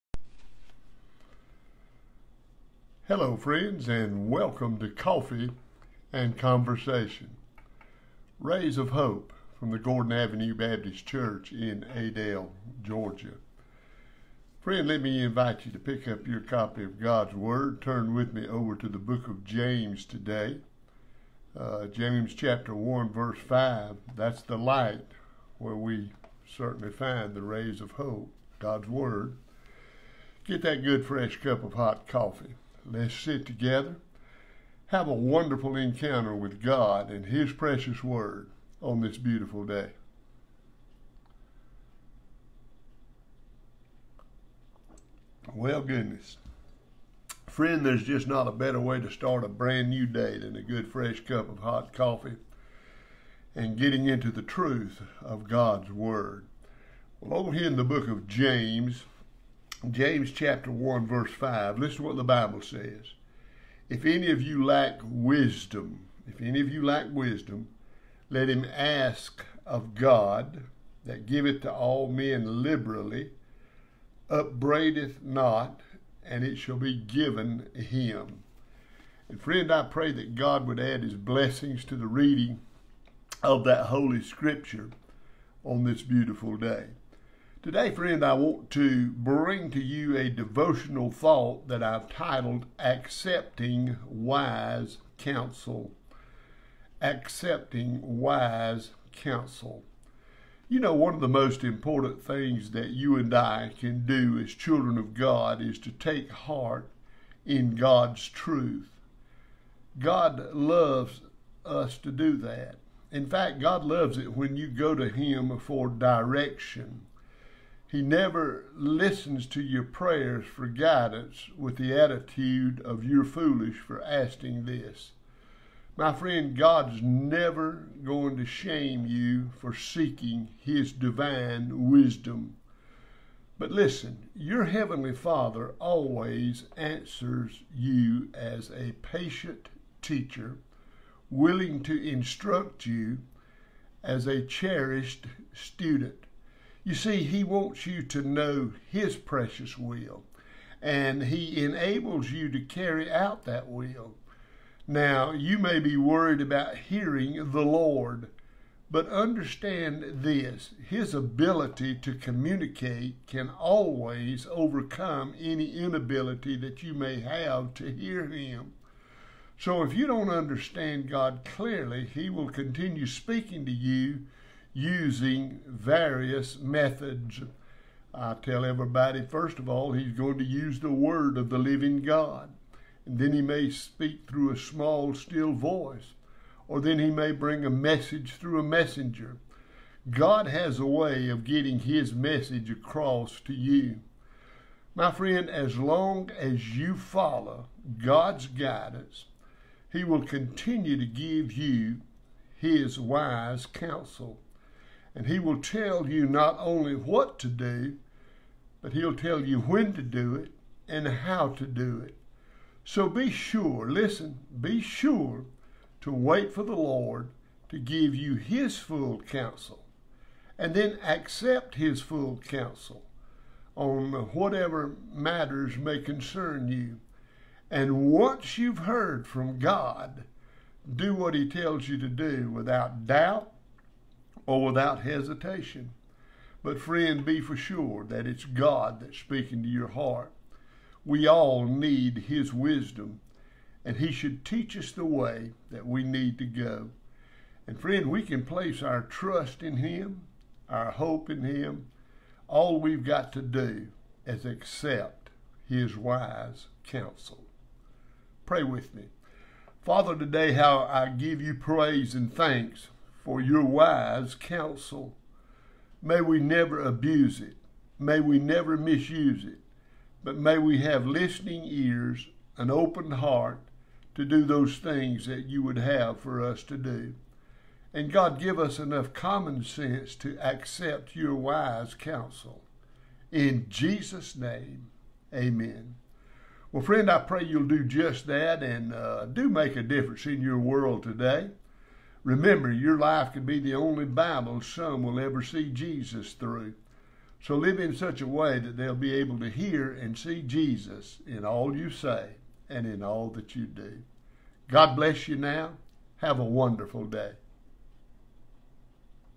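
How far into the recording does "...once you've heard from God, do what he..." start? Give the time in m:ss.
3:48.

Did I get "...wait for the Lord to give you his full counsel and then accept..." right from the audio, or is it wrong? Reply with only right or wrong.
right.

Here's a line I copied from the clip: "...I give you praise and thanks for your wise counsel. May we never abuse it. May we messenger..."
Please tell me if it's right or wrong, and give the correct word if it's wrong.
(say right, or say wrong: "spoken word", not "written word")
wrong: "never", not "messenger".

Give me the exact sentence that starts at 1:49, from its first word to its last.
God loves us to do that.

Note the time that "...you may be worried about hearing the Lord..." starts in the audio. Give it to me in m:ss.
2:35.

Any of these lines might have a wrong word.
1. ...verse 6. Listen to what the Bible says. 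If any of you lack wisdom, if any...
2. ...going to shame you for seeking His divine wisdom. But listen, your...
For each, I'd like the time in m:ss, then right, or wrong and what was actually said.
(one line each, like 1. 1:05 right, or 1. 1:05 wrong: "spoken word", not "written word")
1. 1:01 wrong: "5", not "6"
2. 2:08 right.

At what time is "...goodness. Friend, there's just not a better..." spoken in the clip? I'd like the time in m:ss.
0:45.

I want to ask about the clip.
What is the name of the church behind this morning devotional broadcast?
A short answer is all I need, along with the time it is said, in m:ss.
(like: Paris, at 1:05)
Gordon Avenue Baptist Church, at 0:09.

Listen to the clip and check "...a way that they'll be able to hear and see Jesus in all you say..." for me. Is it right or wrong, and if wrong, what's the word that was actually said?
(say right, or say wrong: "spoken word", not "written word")
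right.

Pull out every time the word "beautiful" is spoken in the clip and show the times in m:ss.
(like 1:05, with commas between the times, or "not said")
0:39, 1:26.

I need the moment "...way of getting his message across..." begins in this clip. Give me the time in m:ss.
3:10.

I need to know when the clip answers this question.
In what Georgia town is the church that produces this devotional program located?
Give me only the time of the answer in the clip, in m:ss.
0:11.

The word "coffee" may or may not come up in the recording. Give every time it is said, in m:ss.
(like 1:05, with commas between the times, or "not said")
0:04, 0:32, 0:51.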